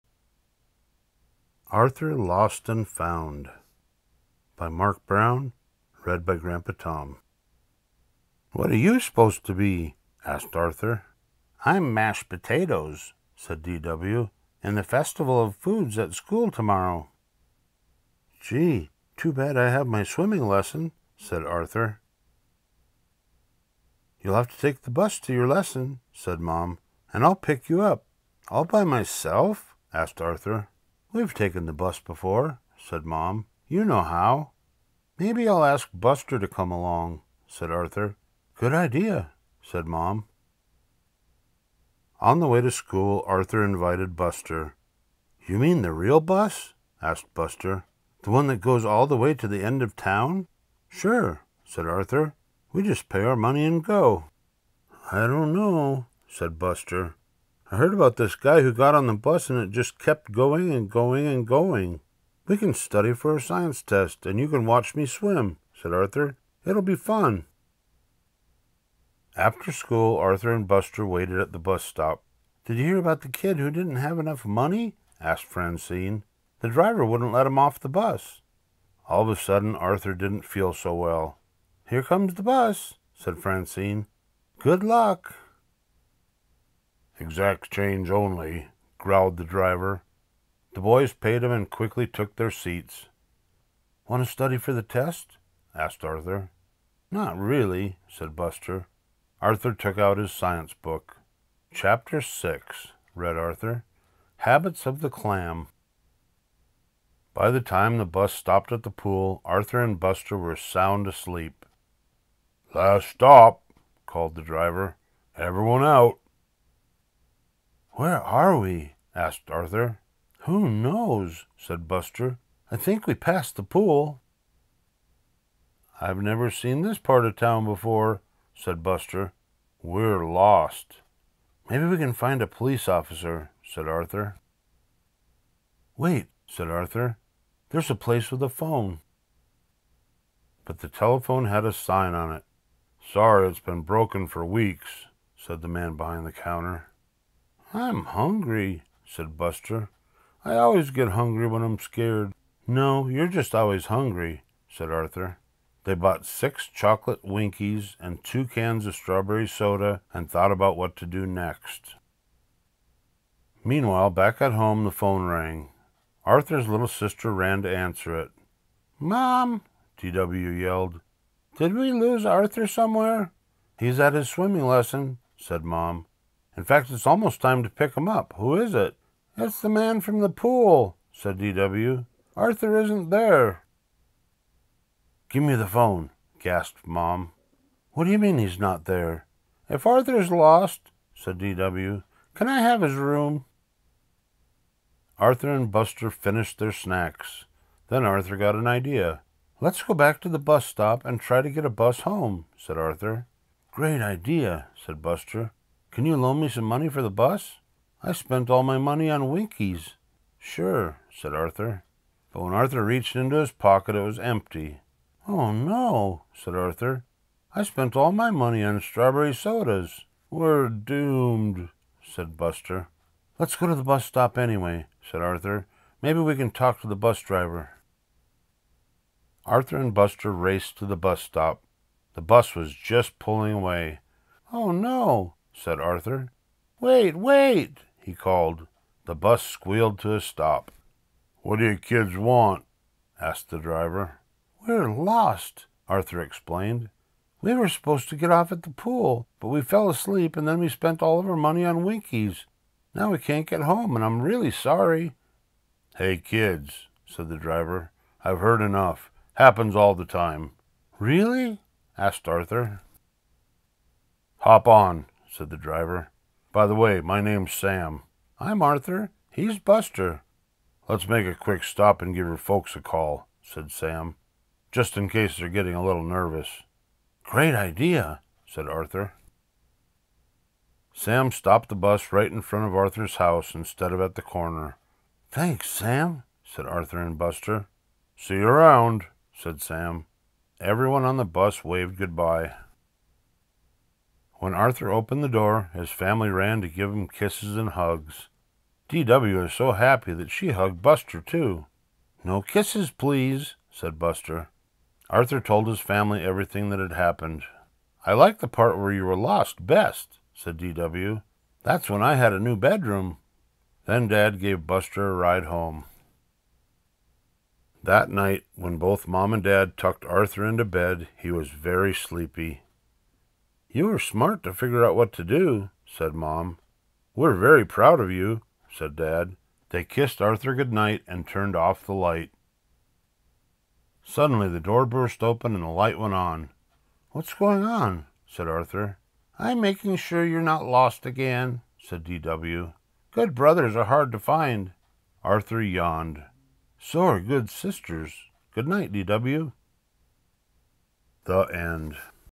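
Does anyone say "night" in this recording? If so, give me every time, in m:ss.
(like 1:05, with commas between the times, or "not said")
5:18, 5:30, 5:48.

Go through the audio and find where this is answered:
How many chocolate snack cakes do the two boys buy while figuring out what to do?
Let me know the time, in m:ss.
2:36.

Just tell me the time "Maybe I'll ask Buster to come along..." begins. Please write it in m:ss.
0:35.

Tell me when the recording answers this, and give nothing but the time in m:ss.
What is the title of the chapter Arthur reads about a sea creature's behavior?
1:44.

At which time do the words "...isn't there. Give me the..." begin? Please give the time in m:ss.
3:02.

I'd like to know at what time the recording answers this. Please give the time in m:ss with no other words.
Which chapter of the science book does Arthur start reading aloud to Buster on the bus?
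1:41.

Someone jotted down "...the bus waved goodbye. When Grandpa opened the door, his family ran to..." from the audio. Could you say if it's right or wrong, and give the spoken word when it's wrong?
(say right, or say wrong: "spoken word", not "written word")
wrong: "Arthur", not "Grandpa".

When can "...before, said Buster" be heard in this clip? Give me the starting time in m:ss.
2:07.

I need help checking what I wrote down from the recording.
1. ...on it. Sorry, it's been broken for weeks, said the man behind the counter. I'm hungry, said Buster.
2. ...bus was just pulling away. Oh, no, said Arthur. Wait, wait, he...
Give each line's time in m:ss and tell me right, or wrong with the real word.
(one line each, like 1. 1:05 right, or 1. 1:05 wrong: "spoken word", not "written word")
1. 2:22 right
2. 3:52 right.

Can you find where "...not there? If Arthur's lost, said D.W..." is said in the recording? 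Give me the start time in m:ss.
3:08.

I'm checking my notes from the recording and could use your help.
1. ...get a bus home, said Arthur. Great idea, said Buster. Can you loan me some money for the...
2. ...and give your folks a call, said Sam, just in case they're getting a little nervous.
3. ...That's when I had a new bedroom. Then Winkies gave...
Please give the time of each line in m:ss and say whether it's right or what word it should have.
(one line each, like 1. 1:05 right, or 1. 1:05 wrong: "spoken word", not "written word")
1. 3:21 right
2. 4:32 right
3. 5:11 wrong: "Dad", not "Winkies".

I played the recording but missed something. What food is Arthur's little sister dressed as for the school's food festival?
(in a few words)
Mashed potatoes.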